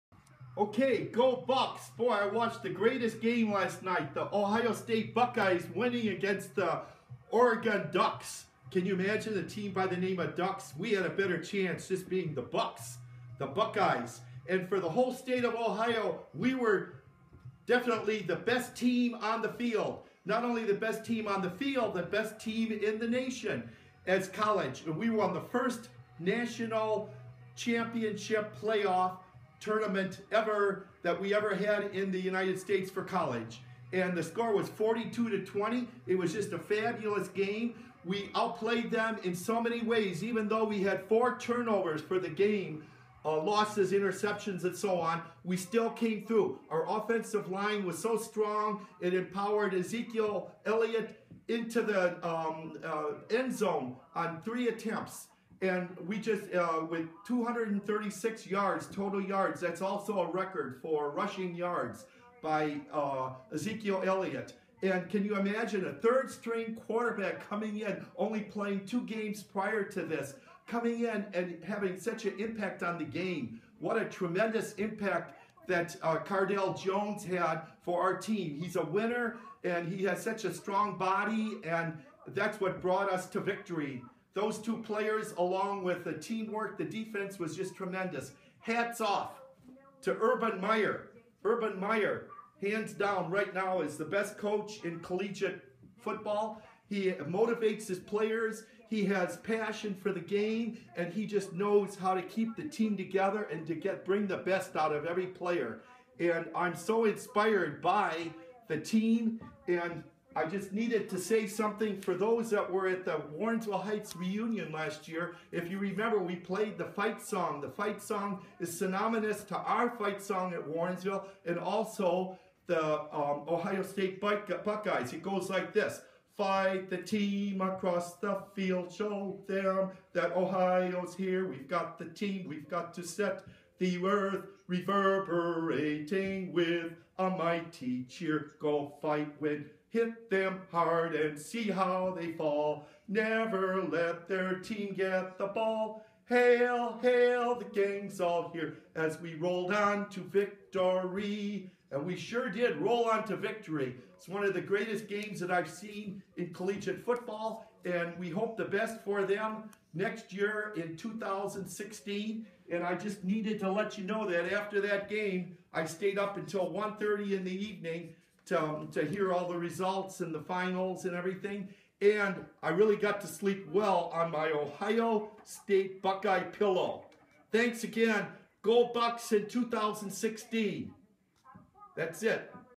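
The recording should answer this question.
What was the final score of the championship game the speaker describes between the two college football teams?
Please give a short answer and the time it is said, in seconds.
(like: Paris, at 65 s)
42 to 20, at 34 s.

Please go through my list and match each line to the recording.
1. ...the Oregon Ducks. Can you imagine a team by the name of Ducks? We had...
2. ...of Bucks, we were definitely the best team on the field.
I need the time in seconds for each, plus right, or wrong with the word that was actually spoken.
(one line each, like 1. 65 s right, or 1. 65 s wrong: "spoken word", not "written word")
1. 6 s right
2. 15 s wrong: "Ohio", not "Bucks".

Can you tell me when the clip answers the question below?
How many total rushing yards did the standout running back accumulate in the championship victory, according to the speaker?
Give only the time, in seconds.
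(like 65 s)
57 s.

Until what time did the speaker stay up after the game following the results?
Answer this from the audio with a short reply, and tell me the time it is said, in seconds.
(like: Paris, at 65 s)
1:30, at 166 s.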